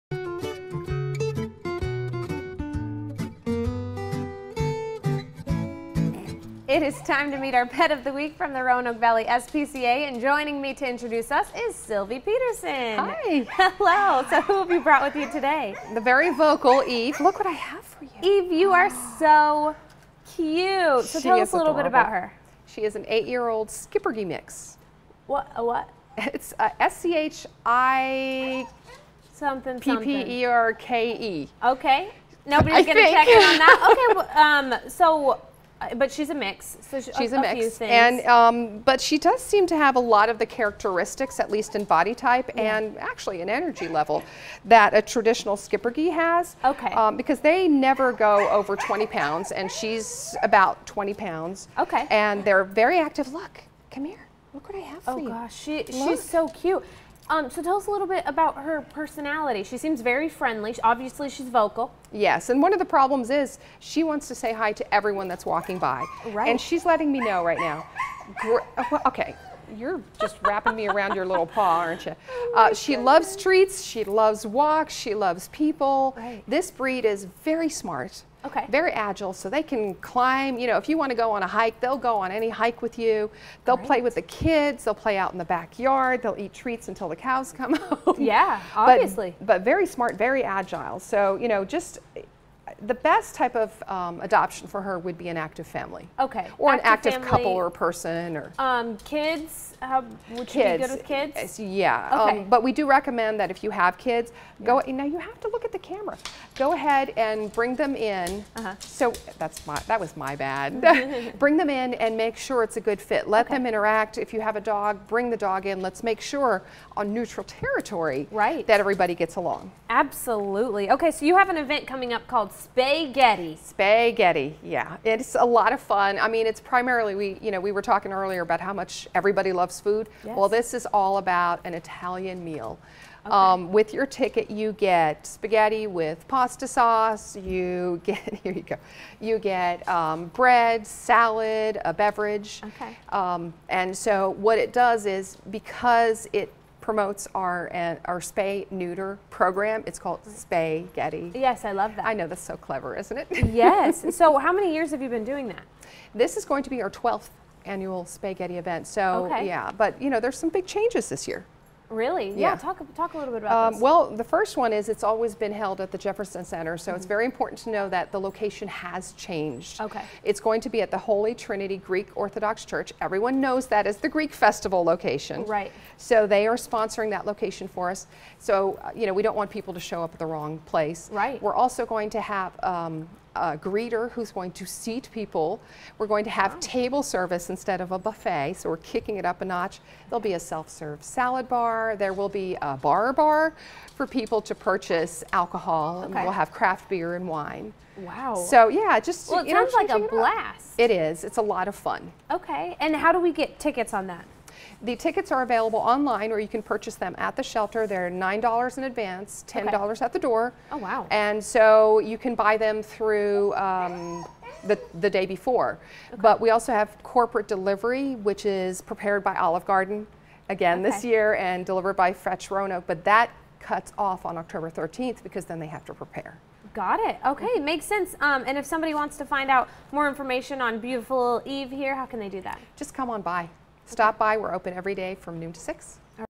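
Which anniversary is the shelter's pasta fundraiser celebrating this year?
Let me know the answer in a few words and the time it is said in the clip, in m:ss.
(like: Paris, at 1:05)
12th, at 2:36.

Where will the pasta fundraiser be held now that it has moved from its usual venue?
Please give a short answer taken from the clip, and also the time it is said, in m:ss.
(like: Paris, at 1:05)
Holy Trinity Greek Orthodox Church, at 2:51.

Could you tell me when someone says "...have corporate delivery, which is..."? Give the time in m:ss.
3:36.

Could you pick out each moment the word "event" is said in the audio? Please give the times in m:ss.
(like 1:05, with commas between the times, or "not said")
2:01, 2:38.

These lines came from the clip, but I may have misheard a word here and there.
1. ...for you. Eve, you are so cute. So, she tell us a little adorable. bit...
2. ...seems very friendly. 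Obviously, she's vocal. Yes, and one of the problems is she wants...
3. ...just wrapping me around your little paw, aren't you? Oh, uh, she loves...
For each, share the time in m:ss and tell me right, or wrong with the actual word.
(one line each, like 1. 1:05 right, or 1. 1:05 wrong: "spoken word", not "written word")
1. 0:17 right
2. 0:59 right
3. 1:10 right.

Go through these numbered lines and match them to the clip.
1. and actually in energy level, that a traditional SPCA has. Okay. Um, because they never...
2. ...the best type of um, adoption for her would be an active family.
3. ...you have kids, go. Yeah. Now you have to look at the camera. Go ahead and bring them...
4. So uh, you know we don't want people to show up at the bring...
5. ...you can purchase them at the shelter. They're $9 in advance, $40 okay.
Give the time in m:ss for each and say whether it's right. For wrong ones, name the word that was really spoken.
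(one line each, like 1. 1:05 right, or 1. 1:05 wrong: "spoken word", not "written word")
1. 0:42 wrong: "Schipperke", not "SPCA"
2. 1:32 right
3. 1:43 right
4. 2:58 wrong: "wrong", not "bring"
5. 3:26 wrong: "10", not "40".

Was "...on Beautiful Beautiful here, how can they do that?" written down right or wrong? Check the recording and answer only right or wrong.
wrong.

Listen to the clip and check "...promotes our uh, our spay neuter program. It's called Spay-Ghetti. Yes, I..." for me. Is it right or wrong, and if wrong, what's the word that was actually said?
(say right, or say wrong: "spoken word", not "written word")
right.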